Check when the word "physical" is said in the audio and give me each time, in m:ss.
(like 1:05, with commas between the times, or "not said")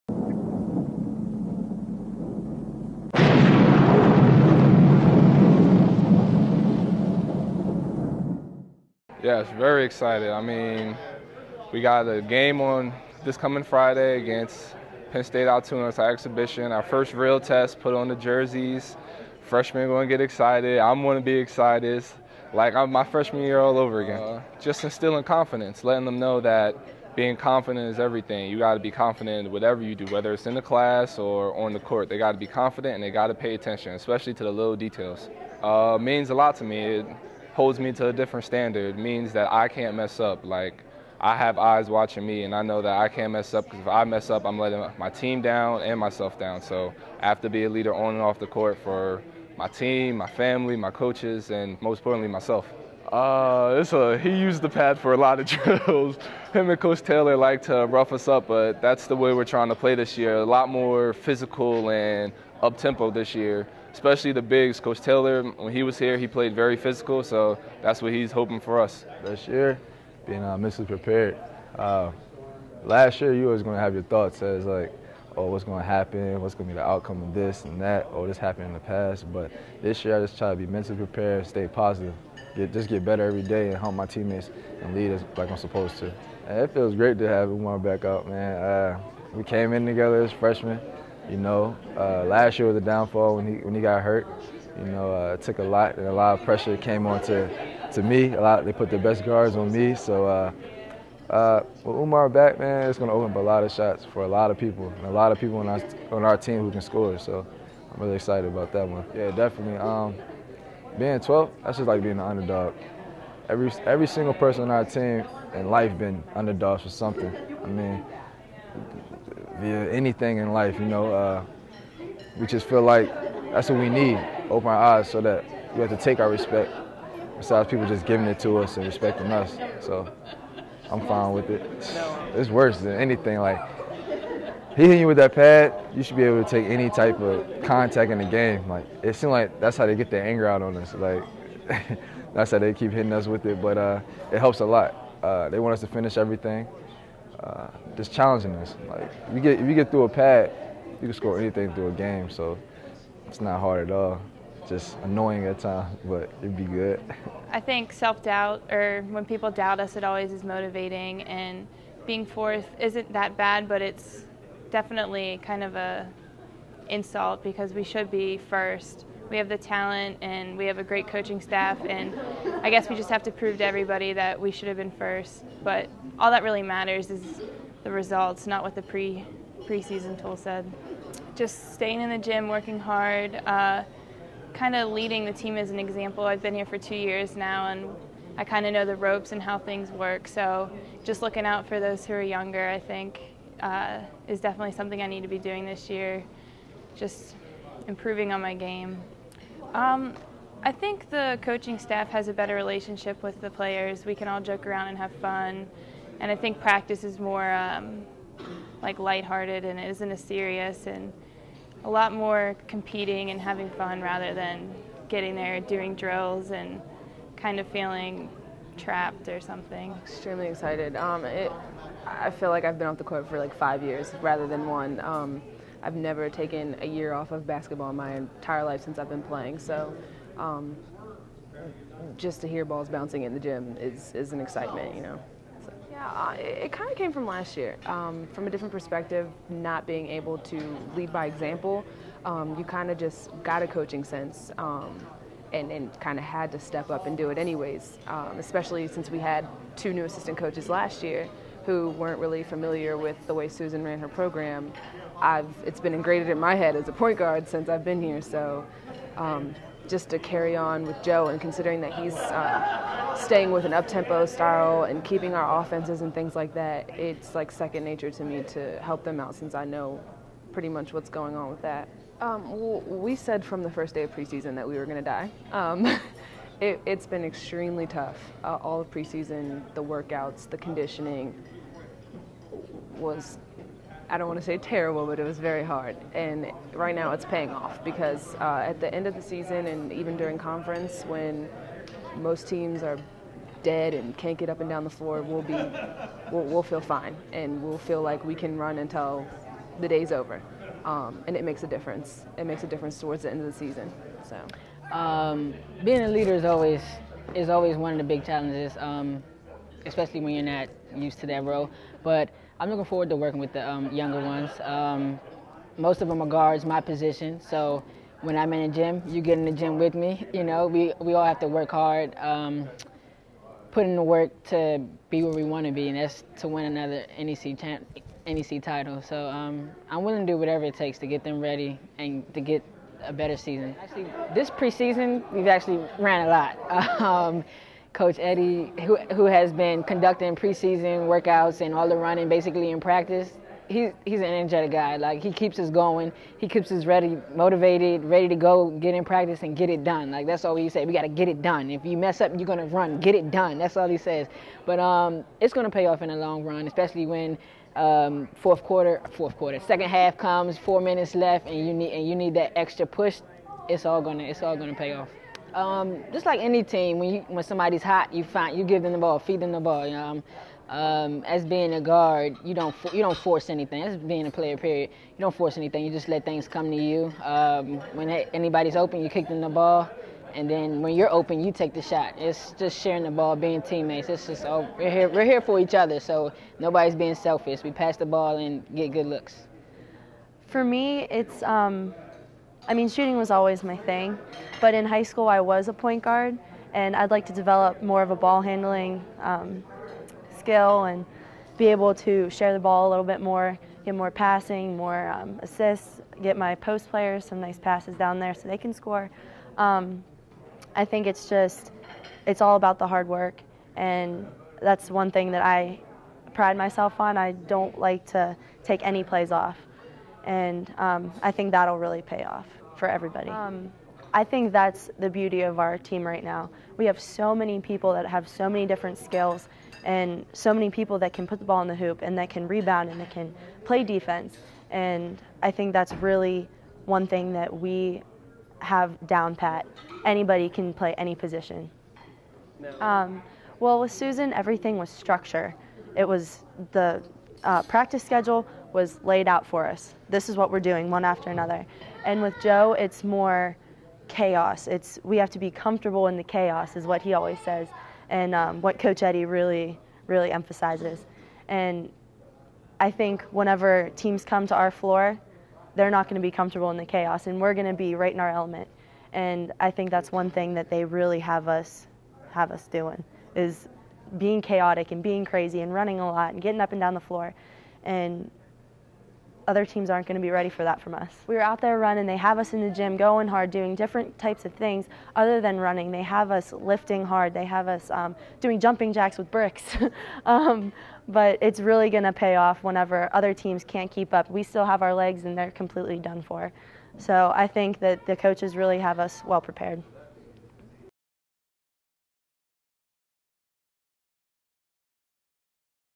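1:01, 1:06.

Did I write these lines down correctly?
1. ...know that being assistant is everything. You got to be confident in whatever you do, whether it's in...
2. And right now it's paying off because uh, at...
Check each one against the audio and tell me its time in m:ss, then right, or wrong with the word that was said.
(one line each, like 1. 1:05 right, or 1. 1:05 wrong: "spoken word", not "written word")
1. 0:26 wrong: "confident", not "assistant"
2. 4:46 right.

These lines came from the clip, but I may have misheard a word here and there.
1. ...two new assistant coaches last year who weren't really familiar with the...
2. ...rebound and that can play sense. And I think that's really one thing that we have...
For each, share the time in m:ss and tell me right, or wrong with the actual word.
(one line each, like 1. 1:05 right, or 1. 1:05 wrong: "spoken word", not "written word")
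1. 4:09 right
2. 7:12 wrong: "defense", not "sense".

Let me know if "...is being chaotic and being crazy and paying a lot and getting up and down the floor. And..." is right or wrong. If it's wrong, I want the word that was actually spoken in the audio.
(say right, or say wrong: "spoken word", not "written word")
wrong: "running", not "paying".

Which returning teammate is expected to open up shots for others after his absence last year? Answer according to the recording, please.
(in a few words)
Umar.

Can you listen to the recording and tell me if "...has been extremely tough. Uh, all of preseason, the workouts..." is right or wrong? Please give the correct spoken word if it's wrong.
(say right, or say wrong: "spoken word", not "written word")
right.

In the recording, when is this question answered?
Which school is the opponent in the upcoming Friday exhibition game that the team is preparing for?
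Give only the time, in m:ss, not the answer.
0:15.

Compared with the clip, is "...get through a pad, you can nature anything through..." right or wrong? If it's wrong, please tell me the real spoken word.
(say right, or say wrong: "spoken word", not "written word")
wrong: "score", not "nature".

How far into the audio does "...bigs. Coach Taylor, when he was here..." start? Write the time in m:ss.
1:04.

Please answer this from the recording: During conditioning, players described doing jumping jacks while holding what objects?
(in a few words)
bricks.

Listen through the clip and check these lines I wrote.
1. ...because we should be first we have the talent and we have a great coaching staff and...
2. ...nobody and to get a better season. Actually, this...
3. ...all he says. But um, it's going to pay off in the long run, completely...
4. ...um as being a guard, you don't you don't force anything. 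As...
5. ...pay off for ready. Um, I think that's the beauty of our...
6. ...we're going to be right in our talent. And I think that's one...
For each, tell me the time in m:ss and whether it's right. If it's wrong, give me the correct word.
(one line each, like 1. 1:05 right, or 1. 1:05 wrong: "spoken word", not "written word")
1. 2:47 right
2. 5:31 wrong: "ready", not "nobody"
3. 5:53 wrong: "especially", not "completely"
4. 6:10 right
5. 7:02 wrong: "everybody", not "ready"
6. 7:47 wrong: "element", not "talent".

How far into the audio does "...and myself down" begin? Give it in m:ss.
0:45.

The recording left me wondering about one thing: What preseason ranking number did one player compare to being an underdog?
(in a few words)
12.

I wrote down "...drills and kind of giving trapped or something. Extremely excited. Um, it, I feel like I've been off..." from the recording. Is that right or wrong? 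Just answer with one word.
wrong.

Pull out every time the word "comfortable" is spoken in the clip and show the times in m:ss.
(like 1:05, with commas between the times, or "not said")
7:35, 7:46.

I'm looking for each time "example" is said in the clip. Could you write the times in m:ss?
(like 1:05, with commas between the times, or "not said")
3:05, 4:01.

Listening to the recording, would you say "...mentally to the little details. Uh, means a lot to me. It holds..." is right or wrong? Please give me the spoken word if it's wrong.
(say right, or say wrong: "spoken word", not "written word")
wrong: "especially", not "mentally".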